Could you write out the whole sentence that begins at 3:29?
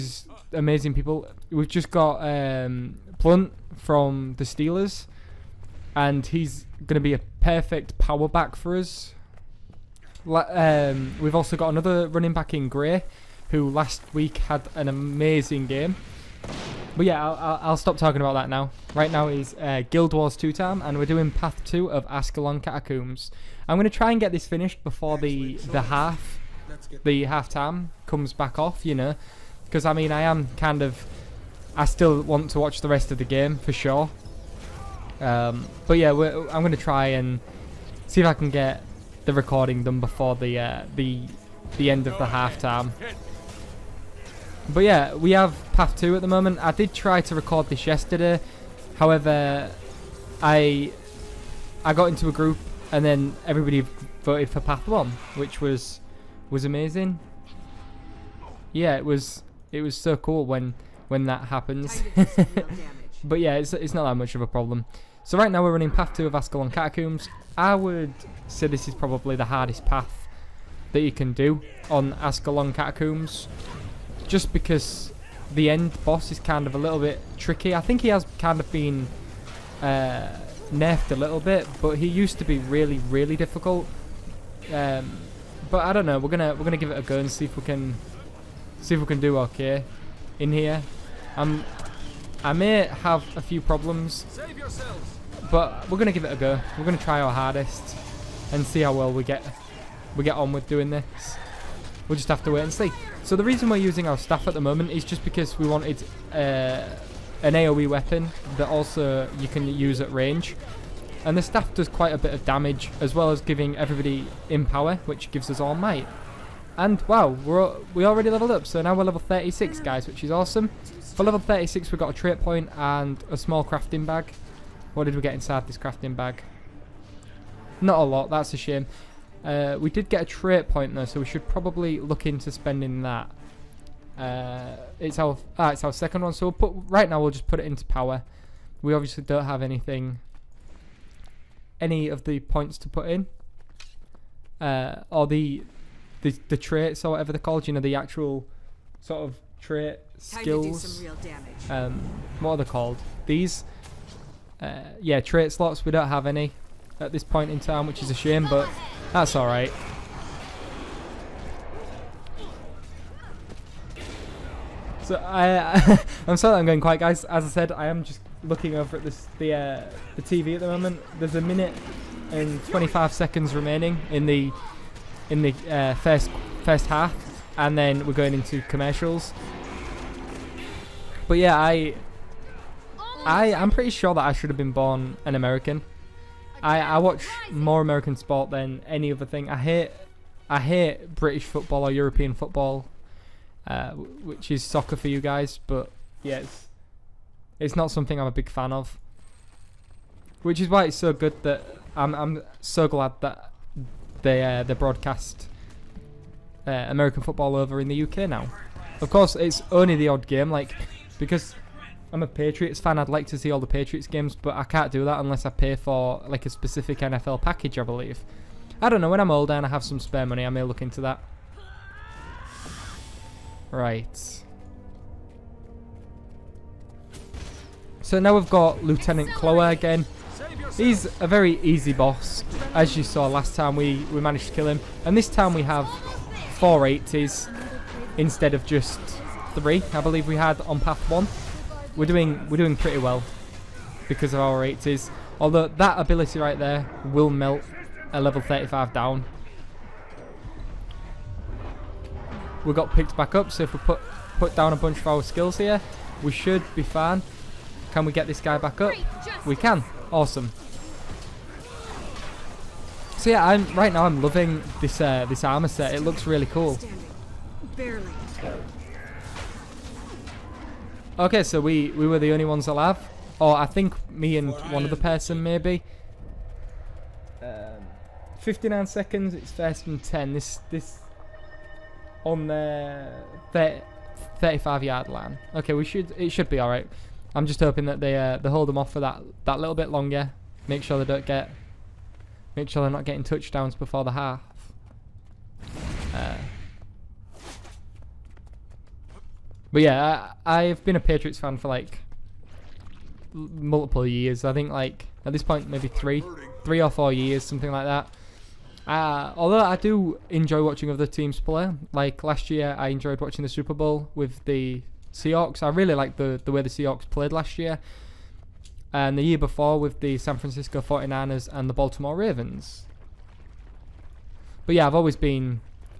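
Of course, it's only the odd game, like because I'm a Patriots fan.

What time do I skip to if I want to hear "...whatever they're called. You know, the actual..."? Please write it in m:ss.
2:27.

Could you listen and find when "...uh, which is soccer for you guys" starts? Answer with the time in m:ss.
3:13.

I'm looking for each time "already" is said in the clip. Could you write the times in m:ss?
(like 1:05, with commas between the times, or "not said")
1:58.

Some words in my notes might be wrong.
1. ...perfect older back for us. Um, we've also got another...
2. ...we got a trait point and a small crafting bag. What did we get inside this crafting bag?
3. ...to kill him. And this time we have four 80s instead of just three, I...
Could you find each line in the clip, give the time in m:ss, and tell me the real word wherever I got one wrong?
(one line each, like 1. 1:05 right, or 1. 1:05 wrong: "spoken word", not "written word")
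1. 0:07 wrong: "power", not "older"
2. 2:01 right
3. 3:54 right.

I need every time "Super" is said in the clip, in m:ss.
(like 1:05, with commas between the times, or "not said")
5:13.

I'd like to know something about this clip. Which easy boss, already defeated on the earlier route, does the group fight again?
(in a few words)
Lieutenant Kholer.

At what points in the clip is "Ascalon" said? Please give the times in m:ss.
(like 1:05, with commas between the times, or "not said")
0:22, 1:06, 1:12.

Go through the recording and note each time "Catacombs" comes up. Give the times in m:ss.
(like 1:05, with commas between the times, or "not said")
0:22, 1:06, 1:12.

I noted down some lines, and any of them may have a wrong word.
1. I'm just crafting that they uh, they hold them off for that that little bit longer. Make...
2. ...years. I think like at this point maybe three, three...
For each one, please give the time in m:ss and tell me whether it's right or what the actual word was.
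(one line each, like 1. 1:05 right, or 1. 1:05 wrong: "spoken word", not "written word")
1. 4:47 wrong: "hoping", not "crafting"
2. 5:04 right.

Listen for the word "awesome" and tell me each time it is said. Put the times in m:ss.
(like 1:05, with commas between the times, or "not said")
2:00, 4:20.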